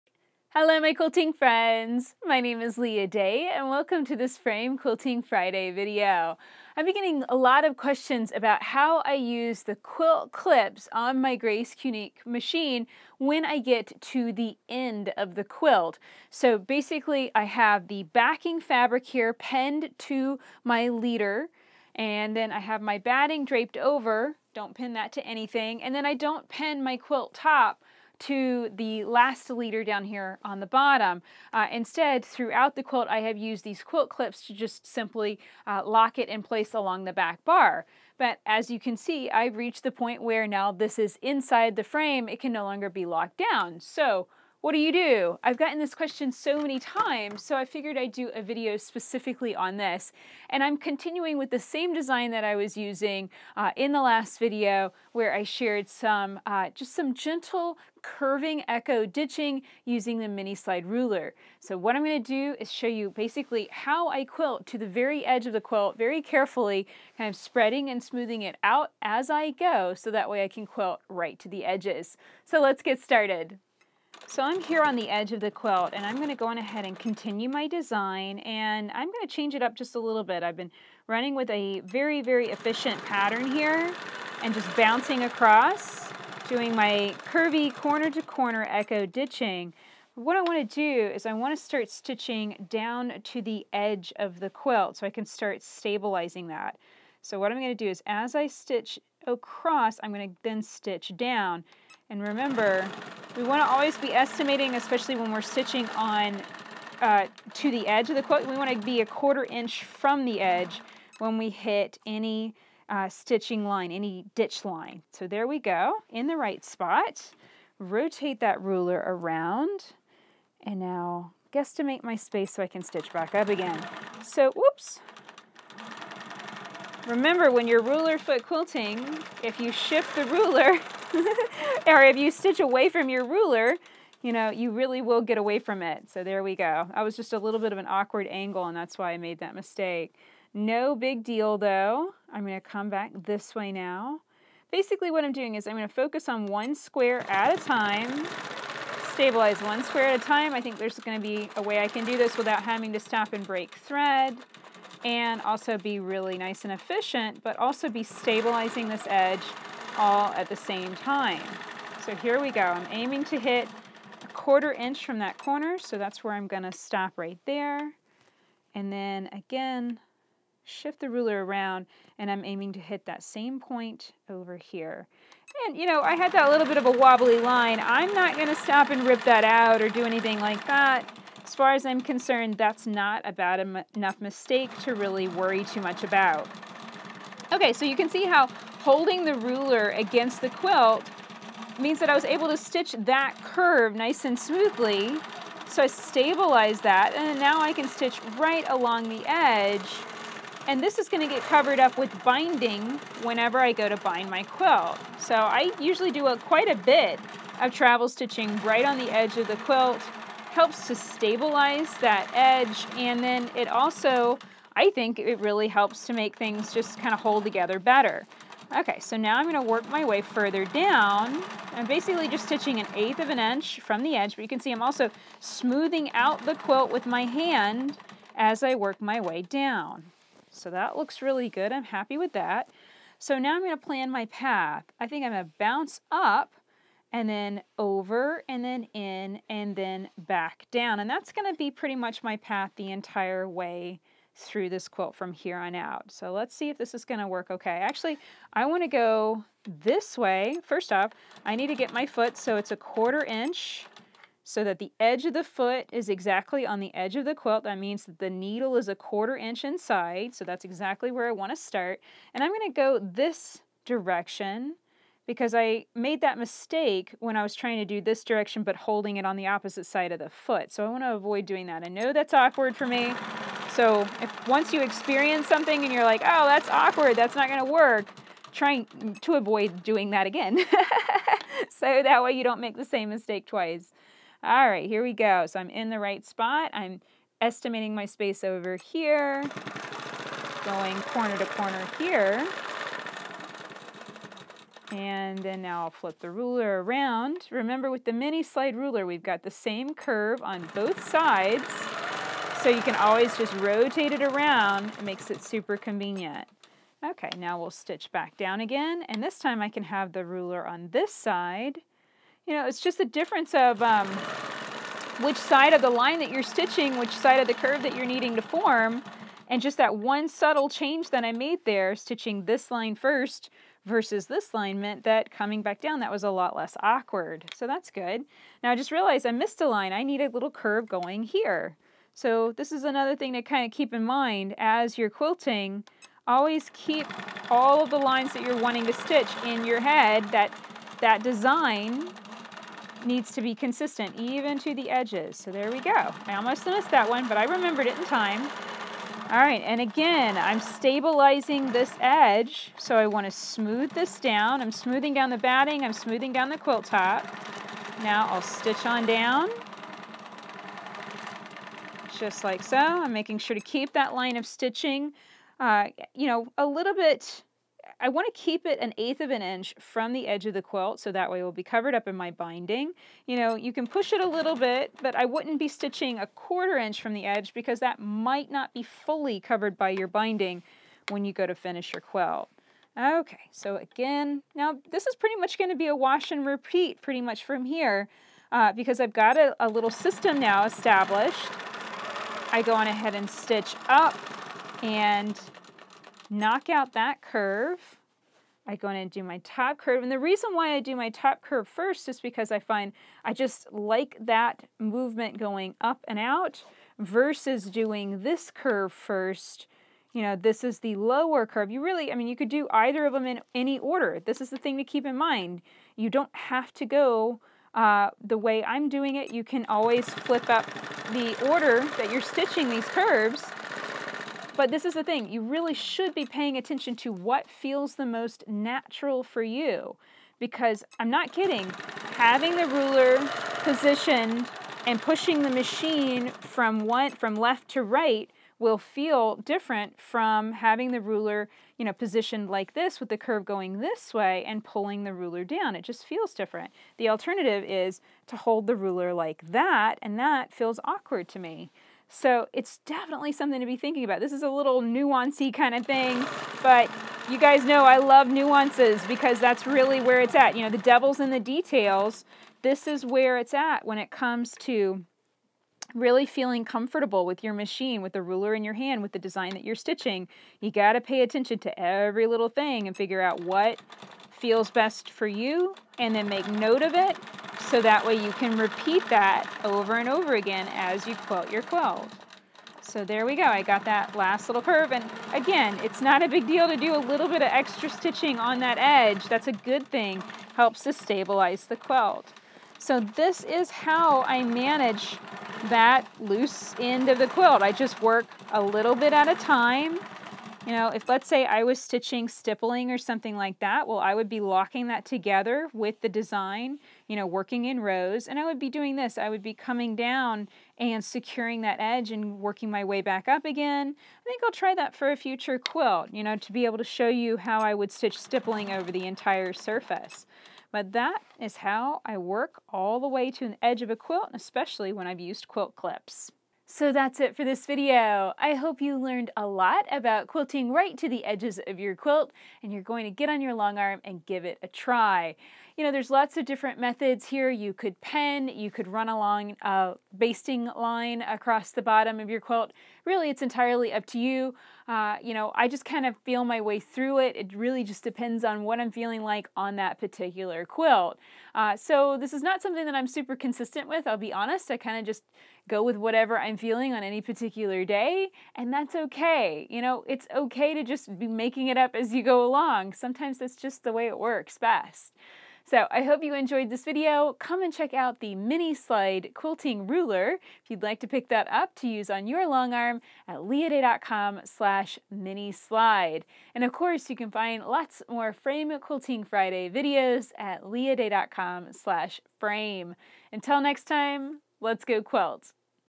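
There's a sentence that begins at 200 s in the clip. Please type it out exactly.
And this is gonna get covered up with binding whenever I go to bind my quilt.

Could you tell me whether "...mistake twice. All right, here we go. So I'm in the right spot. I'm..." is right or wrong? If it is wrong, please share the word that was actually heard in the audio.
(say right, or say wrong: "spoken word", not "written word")
right.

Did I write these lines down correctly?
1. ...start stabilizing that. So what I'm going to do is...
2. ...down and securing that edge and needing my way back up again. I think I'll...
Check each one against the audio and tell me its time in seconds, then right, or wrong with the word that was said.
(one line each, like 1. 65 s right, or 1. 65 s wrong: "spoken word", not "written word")
1. 95 s right
2. 509 s wrong: "working", not "needing".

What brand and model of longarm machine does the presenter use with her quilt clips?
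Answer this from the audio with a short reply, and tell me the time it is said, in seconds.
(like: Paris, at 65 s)
Grace Qnique, at 11 s.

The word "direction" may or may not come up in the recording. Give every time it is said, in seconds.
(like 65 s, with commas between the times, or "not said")
263 s, 268 s.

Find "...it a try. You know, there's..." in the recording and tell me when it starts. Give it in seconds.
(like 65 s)
534 s.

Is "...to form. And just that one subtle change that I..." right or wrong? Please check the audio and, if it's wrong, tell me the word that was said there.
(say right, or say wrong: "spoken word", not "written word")
right.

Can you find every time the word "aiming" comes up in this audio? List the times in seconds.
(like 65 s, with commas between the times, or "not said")
162 s, 172 s.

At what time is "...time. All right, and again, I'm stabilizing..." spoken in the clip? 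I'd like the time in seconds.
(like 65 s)
348 s.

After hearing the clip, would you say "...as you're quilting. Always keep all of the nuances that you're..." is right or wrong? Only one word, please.
wrong.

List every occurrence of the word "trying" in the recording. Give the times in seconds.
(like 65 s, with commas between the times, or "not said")
267 s, 278 s.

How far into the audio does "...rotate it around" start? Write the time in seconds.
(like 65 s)
303 s.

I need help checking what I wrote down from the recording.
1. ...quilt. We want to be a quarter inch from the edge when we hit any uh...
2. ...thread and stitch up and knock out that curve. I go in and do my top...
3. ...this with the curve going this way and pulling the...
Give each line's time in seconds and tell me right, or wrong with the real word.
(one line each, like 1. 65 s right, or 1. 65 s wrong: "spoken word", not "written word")
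1. 108 s right
2. 392 s wrong: "ahead", not "thread"
3. 442 s right.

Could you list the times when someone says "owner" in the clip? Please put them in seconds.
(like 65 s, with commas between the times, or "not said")
not said.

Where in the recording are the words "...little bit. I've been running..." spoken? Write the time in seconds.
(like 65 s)
79 s.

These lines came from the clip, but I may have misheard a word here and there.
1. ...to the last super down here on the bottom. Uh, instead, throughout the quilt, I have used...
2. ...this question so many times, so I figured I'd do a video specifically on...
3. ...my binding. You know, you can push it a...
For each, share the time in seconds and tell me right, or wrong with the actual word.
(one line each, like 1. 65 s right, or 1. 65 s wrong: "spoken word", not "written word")
1. 28 s wrong: "leader", not "super"
2. 45 s right
3. 372 s right.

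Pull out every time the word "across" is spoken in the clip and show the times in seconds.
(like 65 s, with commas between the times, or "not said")
85 s, 99 s, 541 s.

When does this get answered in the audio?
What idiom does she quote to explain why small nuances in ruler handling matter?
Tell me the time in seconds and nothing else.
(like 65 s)
460 s.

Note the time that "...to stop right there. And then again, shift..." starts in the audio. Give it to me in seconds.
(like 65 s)
166 s.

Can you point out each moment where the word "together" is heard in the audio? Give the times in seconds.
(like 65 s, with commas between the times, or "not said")
217 s, 505 s.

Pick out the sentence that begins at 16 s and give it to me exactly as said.
So basically, I have the backing fabric here pinned to my leader, and then I have my batting draped over.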